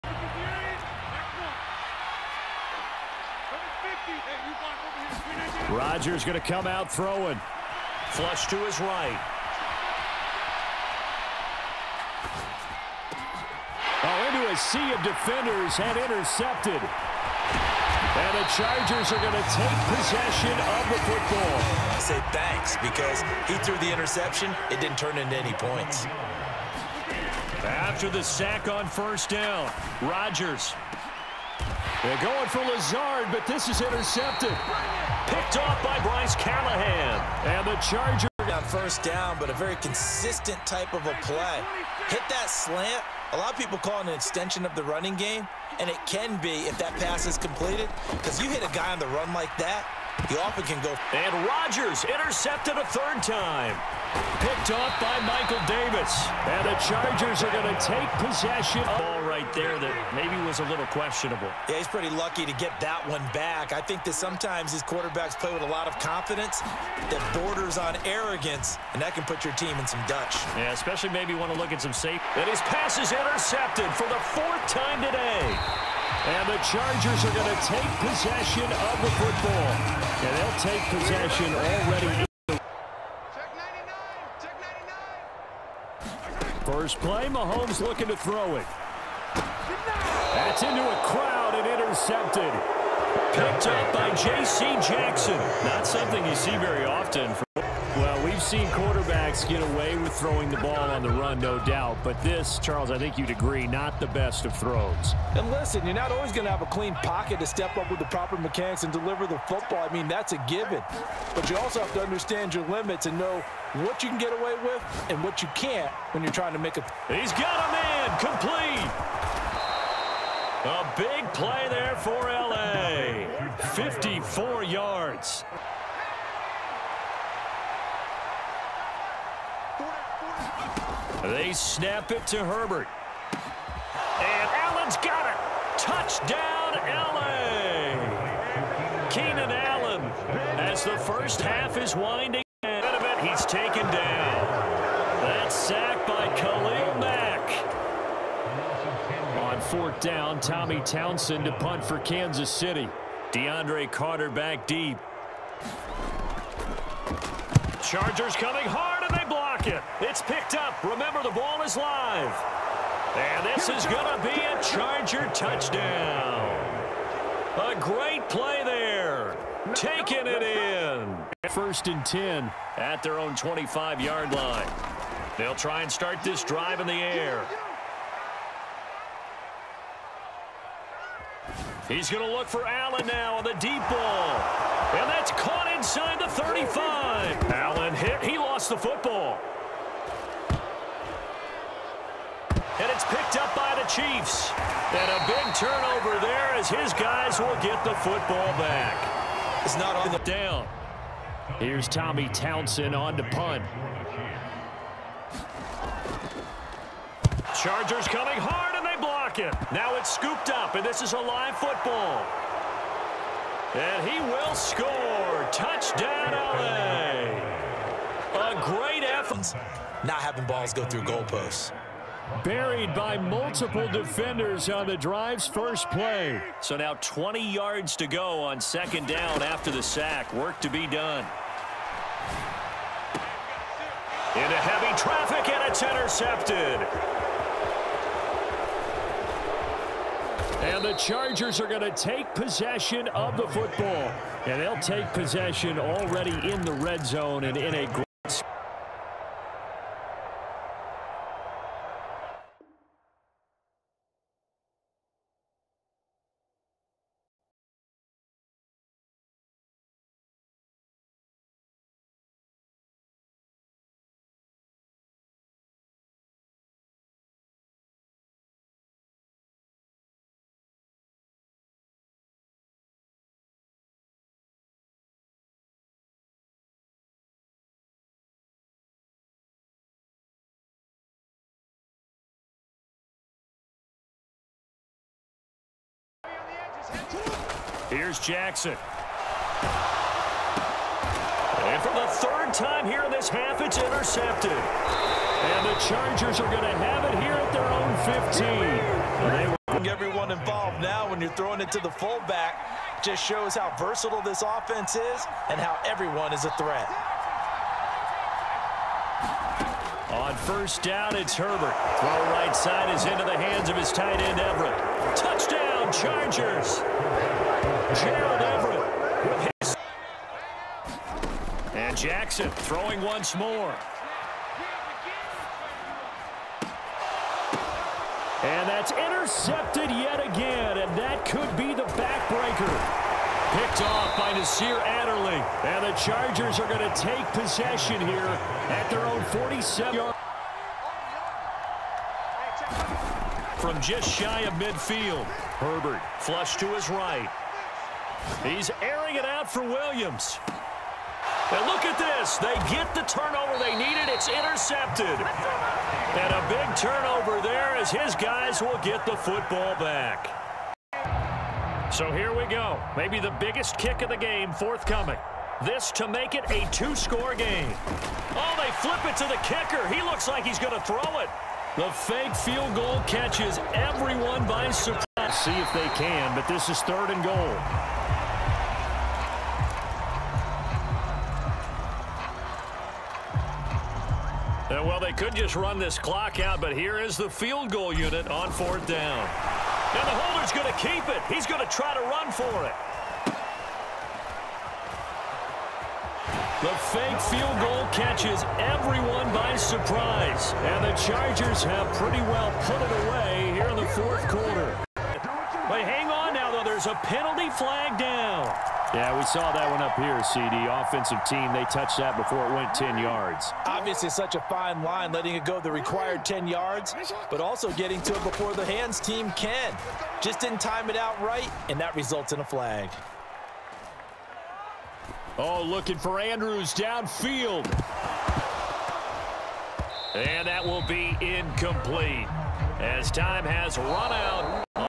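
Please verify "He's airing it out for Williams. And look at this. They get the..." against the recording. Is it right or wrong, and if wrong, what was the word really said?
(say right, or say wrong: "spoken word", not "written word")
right.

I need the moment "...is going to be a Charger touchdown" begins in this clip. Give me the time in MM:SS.
02:43.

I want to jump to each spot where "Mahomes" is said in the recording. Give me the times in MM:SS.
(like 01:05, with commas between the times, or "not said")
01:27.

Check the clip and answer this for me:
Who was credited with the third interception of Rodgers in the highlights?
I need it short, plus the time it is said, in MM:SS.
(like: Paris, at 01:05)
Michael Davis, at 00:55.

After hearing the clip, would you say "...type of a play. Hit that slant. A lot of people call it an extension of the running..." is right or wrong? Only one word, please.
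right.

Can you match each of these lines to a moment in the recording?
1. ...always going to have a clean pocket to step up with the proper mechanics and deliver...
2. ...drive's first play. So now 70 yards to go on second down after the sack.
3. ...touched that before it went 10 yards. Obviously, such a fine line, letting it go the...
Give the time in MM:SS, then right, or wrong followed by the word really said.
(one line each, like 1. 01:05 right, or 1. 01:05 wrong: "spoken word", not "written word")
1. 01:46 right
2. 03:44 wrong: "20", not "70"
3. 06:51 right.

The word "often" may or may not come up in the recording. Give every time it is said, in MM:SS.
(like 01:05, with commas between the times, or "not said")
00:50, 01:36.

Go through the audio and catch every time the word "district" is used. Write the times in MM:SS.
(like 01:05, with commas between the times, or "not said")
not said.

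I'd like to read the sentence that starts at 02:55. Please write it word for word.
They'll try and start this drive in the air.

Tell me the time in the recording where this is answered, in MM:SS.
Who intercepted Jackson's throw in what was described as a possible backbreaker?
05:34.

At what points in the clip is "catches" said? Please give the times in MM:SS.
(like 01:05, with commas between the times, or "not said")
06:13, 06:37.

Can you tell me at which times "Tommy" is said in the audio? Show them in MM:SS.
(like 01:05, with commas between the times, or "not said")
02:30, 03:21.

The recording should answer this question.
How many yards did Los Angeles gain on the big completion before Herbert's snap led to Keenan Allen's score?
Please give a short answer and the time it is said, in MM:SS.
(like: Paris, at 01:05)
54, at 02:03.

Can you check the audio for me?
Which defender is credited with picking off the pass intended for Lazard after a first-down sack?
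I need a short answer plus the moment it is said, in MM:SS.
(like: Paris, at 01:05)
Bryce Callahan, at 00:35.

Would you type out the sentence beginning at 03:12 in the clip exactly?
And it's picked up by the Chiefs.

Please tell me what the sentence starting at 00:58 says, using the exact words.
Oh, ball right there that maybe was a little questionable.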